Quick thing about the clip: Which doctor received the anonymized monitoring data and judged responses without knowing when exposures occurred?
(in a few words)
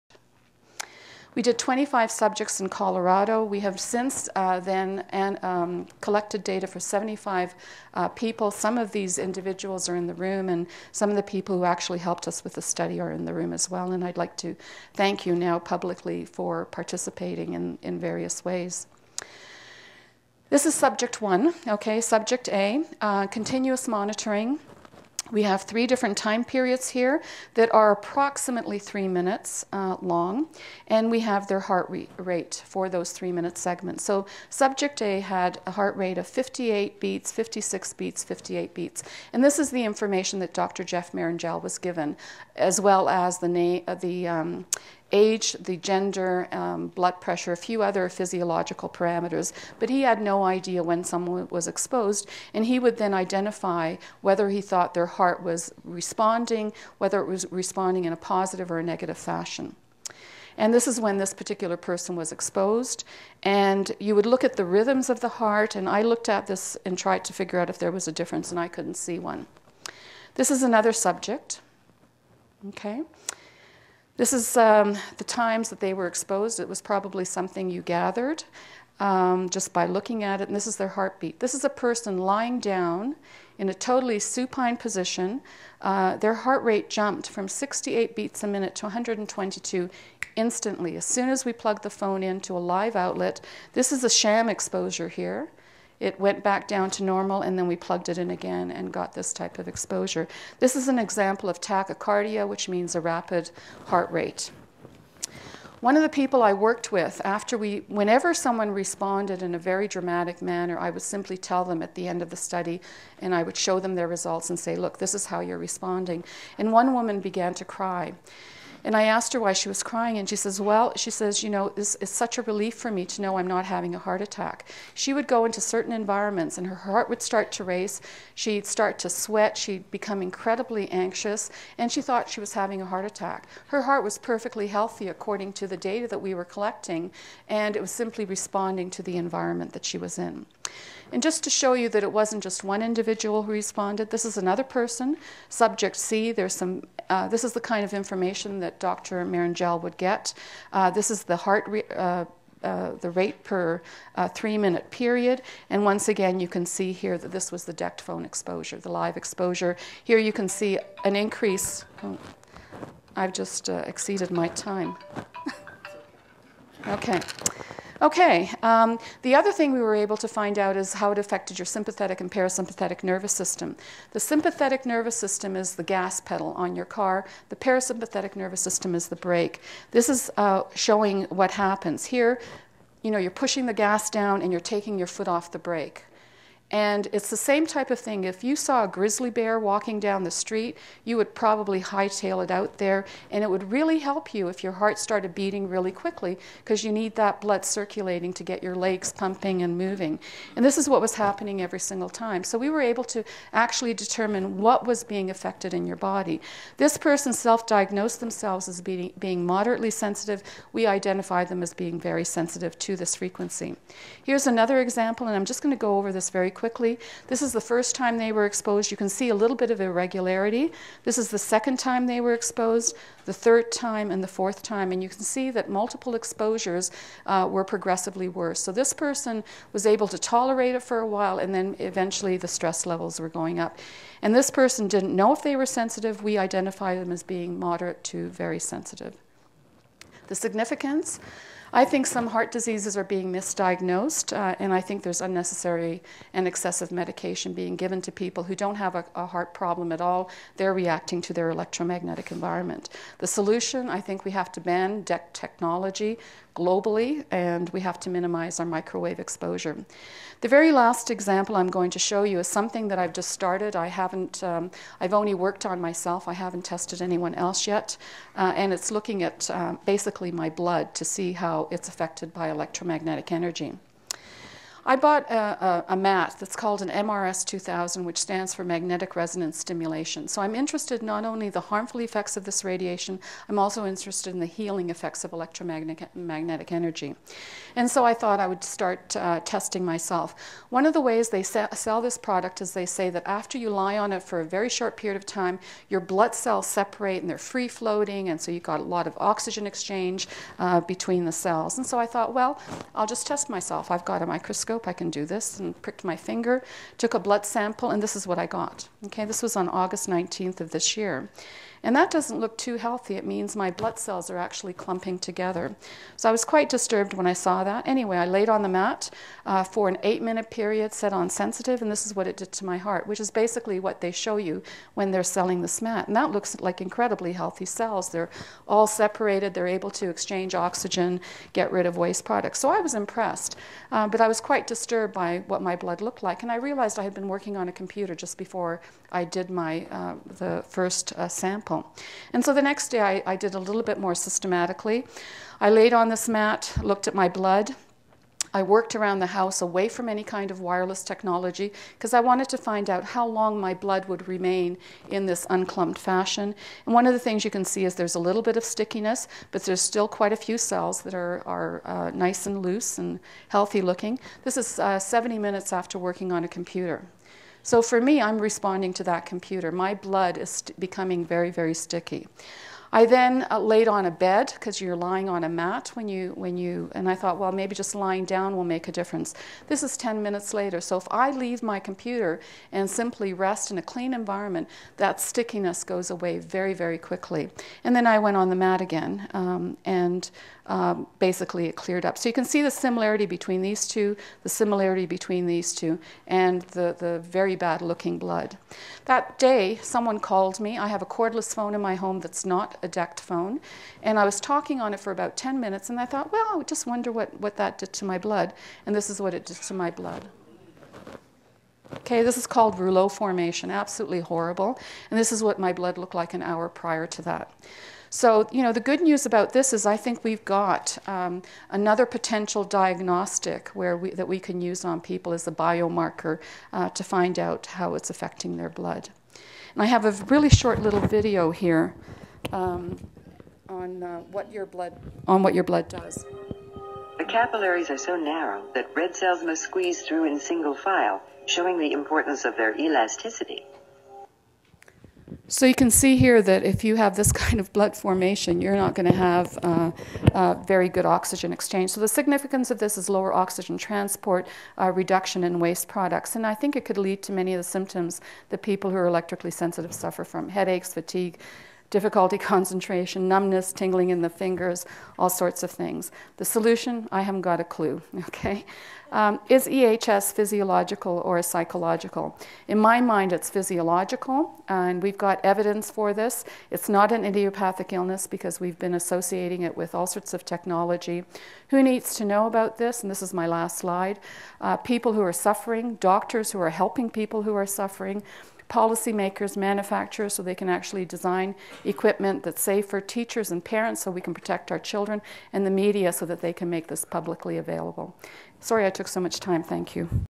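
Jeff Marrongelle.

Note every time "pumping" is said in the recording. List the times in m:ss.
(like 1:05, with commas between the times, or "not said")
3:19.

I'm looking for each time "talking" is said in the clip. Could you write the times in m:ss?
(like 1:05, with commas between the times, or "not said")
6:44.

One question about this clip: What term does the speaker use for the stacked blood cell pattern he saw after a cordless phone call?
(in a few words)
rouleau formation.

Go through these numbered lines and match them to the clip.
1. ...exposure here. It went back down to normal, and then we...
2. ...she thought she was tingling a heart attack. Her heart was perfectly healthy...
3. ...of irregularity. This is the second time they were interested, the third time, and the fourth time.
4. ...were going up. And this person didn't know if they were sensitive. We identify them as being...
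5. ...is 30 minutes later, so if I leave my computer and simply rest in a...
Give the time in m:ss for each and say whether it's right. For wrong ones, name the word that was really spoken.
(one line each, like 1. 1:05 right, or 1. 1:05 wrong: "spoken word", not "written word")
1. 1:34 right
2. 2:11 wrong: "having", not "tingling"
3. 3:39 wrong: "exposed", not "interested"
4. 3:53 right
5. 6:19 wrong: "10", not "30".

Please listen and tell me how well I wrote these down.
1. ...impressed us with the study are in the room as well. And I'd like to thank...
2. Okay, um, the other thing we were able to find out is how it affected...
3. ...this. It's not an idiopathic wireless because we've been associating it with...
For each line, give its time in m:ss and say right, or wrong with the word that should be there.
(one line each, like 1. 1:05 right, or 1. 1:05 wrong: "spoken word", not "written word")
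1. 0:11 wrong: "helped", not "impressed"
2. 2:48 right
3. 7:56 wrong: "illness", not "wireless".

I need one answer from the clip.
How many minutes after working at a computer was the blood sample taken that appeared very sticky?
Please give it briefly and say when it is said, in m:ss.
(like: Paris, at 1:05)
70, at 6:04.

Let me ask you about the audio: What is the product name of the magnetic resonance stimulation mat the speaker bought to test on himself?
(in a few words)
MRS 2000.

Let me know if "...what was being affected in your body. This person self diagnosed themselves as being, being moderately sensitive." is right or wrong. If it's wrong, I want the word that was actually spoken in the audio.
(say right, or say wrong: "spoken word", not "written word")
right.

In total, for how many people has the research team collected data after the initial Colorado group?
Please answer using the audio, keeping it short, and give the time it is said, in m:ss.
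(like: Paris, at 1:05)
75, at 0:06.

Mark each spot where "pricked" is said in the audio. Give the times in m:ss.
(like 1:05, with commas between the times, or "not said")
5:05.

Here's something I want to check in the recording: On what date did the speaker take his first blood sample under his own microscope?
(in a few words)
August 19.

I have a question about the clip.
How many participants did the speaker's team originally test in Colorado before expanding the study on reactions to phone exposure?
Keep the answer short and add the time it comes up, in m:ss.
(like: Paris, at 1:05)
25, at 0:01.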